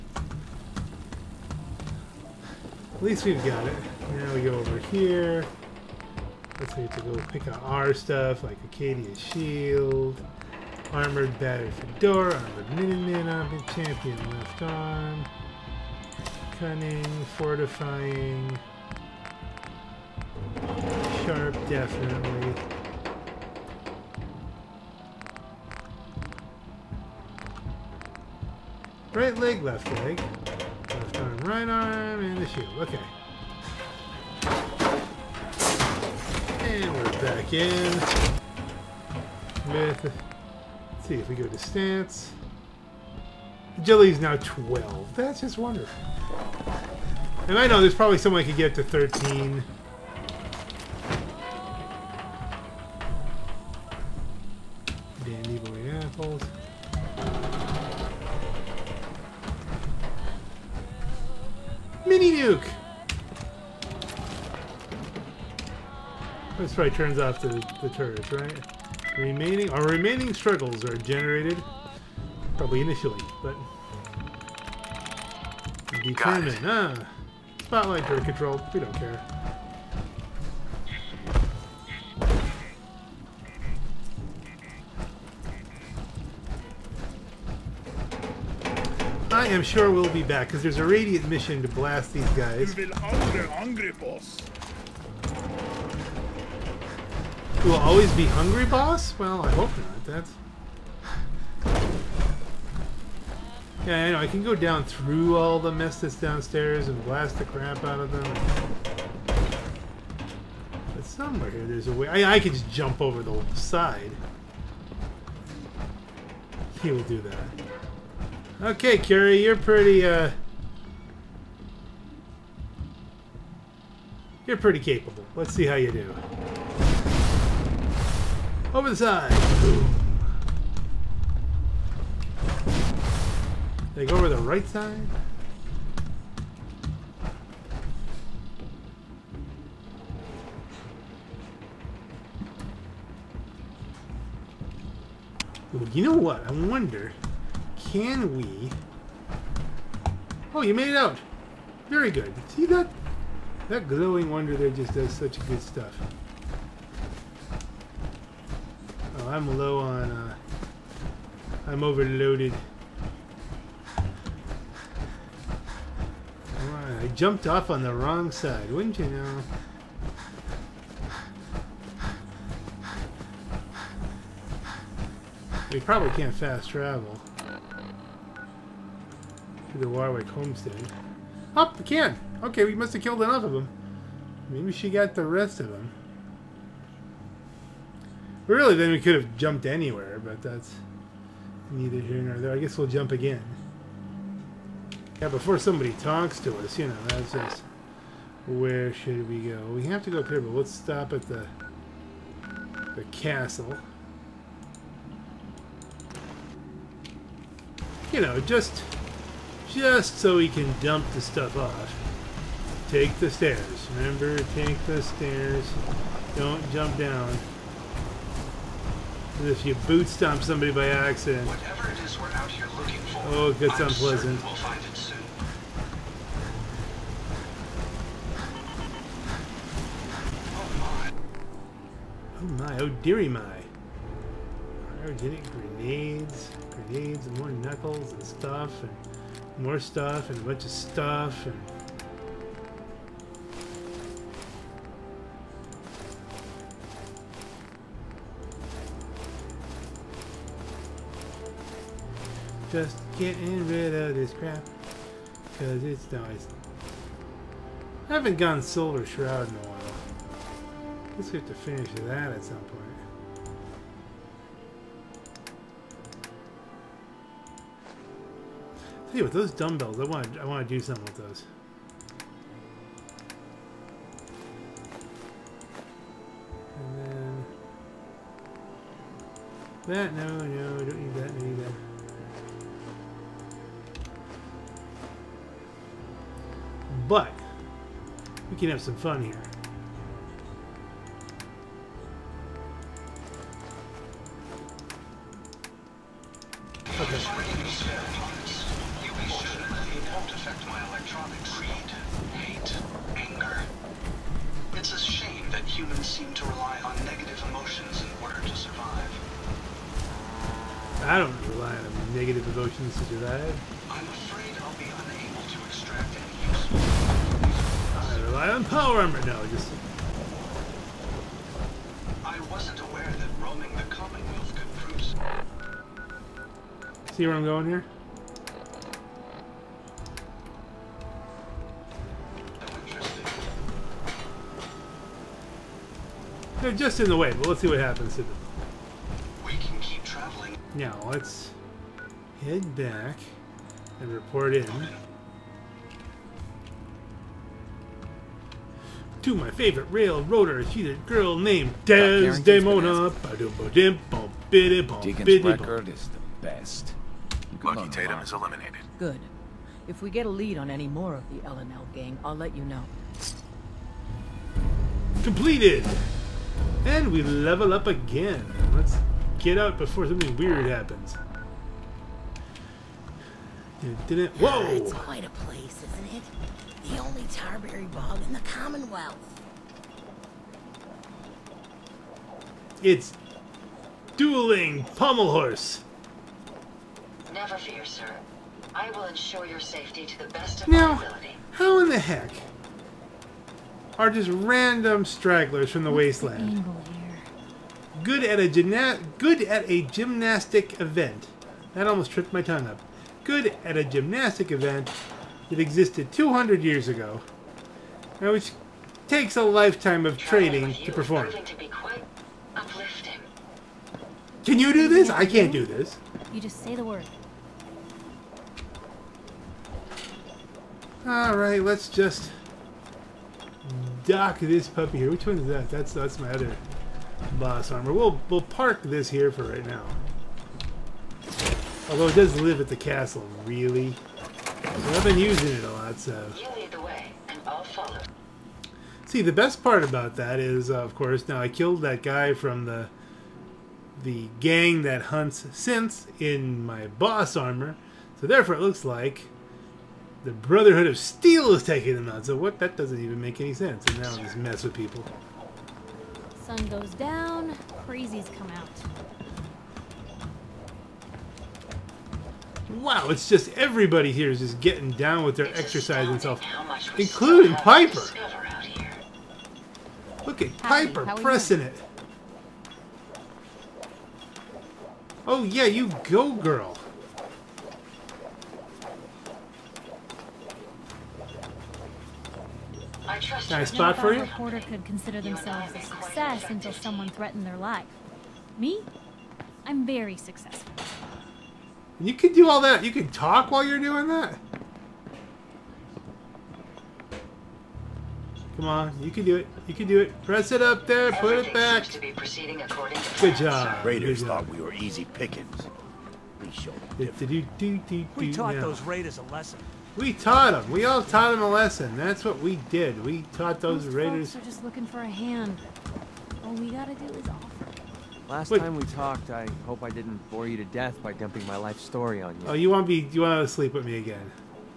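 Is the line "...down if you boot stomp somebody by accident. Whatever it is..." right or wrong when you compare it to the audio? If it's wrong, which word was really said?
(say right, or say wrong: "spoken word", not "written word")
right.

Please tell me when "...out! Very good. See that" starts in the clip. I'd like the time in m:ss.
2:30.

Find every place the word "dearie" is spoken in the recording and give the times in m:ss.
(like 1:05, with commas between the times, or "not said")
3:53.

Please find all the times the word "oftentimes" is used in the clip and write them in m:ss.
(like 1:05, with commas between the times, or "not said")
not said.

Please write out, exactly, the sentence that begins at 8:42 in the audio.
Oh, you want to be you want to sleep with me again?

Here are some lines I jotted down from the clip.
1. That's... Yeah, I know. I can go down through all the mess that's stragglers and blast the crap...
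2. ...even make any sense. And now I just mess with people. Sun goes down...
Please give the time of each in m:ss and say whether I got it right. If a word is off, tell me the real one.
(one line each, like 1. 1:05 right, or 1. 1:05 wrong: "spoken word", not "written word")
1. 1:40 wrong: "downstairs", not "stragglers"
2. 7:33 right.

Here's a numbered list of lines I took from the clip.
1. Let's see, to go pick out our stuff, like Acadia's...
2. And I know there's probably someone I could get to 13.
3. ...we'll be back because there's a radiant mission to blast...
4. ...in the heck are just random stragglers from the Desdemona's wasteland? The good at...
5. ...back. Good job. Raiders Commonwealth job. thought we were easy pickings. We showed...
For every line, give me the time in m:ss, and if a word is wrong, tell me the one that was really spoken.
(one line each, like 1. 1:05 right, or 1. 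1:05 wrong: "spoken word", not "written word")
1. 0:06 right
2. 0:47 right
3. 1:29 right
4. 6:31 wrong: "What", not "Desdemona"
5. 8:22 wrong: "Good", not "Commonwealth".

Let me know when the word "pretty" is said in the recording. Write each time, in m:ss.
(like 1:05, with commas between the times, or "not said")
1:59, 2:04.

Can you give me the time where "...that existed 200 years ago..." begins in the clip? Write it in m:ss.
6:45.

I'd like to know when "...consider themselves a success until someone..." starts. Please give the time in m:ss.
8:04.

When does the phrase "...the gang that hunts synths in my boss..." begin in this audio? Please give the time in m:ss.
7:24.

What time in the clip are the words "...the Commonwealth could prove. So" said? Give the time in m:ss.
5:23.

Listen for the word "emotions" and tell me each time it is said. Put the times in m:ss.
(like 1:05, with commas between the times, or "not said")
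5:07, 5:12.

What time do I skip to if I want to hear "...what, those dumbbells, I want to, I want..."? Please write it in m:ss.
4:29.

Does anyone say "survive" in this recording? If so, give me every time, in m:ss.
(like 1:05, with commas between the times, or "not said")
5:08, 5:13.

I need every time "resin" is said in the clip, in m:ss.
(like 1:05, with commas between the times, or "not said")
not said.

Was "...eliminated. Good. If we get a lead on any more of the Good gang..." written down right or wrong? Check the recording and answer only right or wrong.
wrong.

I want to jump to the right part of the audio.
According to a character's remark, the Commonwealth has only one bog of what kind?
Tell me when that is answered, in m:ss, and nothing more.
6:17.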